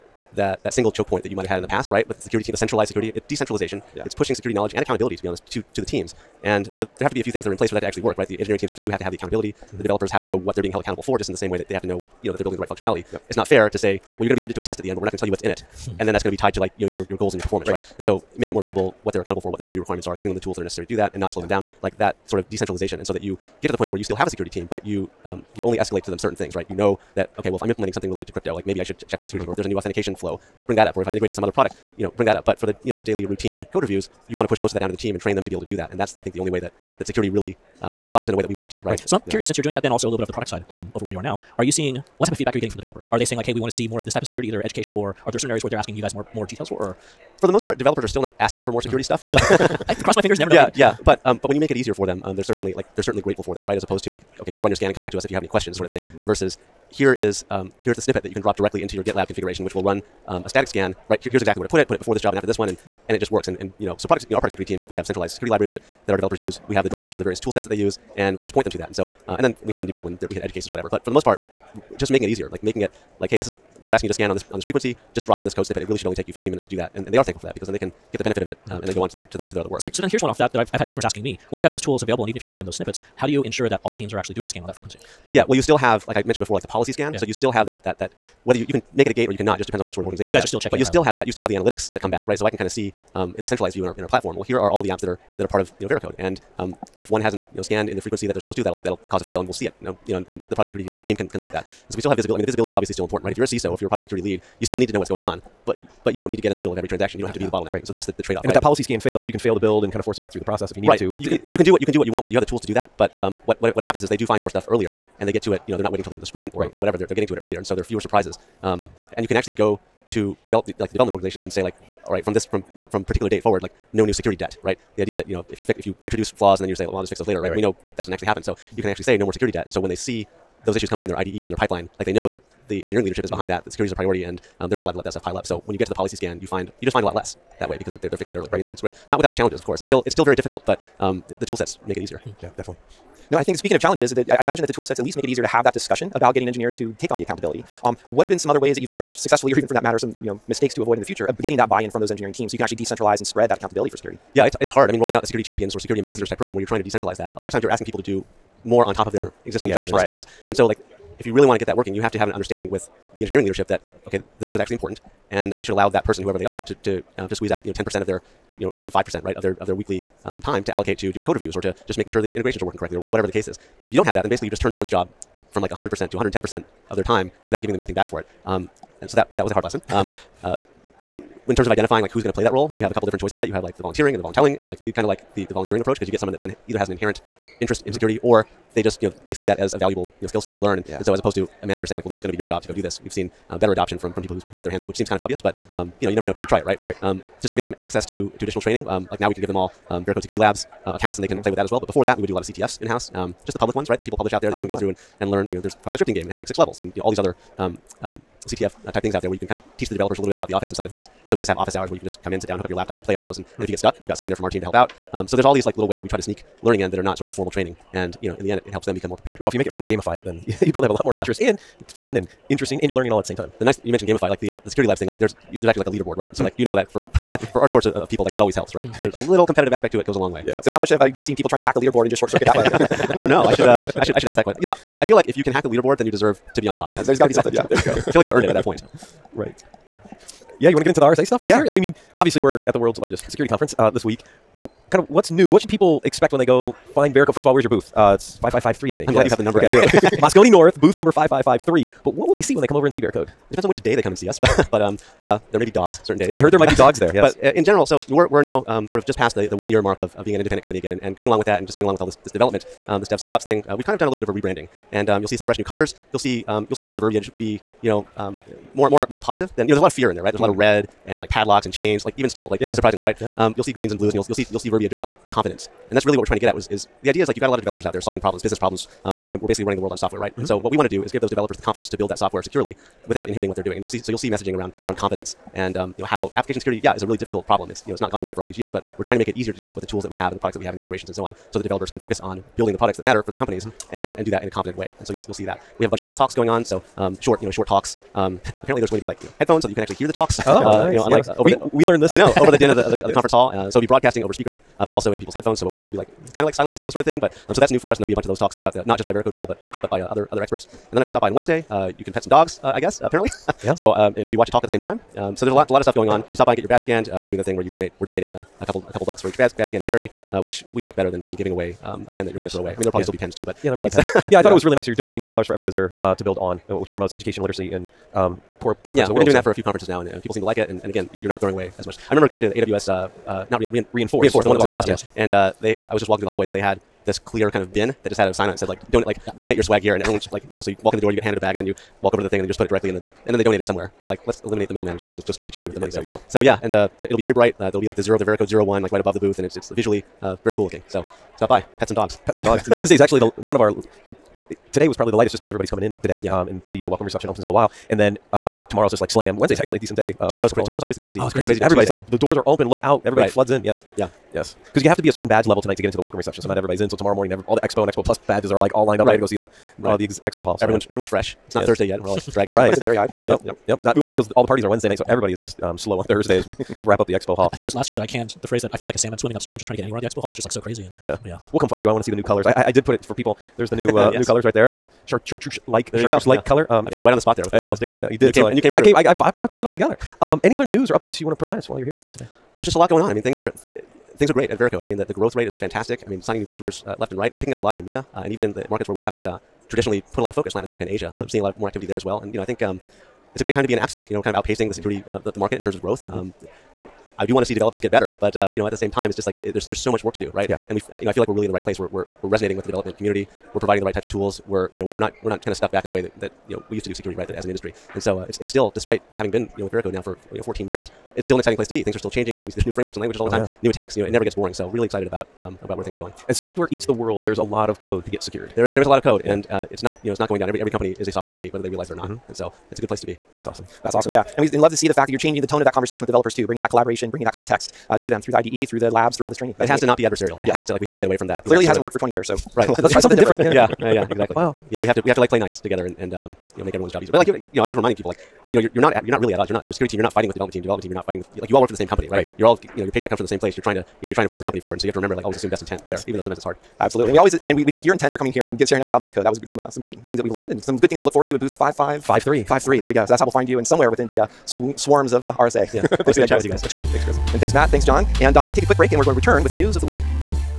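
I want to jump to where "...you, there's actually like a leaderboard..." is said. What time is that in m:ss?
3:45.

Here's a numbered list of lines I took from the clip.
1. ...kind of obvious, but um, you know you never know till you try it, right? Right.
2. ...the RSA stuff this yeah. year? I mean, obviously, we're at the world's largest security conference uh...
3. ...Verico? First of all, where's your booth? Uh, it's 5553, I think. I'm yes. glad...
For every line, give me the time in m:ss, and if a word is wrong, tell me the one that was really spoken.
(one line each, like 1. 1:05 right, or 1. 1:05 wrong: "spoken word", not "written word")
1. 3:15 right
2. 4:00 right
3. 4:07 right.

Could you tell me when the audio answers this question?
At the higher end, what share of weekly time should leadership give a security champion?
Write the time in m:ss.
2:47.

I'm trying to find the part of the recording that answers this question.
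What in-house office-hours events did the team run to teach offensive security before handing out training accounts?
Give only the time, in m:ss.
3:22.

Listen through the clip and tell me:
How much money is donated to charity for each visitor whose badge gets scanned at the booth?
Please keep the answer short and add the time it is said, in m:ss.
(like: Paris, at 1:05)
$2, at 5:25.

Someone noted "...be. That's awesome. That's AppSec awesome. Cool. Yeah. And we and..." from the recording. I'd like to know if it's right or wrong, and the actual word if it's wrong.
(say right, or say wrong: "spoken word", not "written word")
wrong: "Very", not "AppSec".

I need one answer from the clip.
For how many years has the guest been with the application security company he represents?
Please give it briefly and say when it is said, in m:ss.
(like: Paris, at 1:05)
14 years, at 7:00.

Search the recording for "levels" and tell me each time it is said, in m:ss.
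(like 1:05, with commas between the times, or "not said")
3:26, 6:05.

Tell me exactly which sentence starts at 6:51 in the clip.
We're we're we're resonating with the development community we're providing the right types of tools.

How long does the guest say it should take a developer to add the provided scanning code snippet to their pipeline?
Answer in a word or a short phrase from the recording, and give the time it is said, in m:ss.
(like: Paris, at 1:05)
15 minutes, at 1:16.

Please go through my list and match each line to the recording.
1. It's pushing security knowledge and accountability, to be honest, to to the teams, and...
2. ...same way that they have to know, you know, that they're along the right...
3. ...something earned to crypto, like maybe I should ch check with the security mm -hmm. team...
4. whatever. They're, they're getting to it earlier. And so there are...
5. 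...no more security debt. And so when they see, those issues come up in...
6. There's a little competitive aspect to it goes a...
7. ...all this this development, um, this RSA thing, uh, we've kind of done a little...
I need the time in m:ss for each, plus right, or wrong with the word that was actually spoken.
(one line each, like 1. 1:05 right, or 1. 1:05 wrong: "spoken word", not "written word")
1. 0:04 right
2. 0:11 wrong: "building", not "along"
3. 0:27 wrong: "related", not "earned"
4. 1:56 right
5. 2:09 right
6. 3:49 right
7. 4:22 wrong: "DevSecOps", not "RSA".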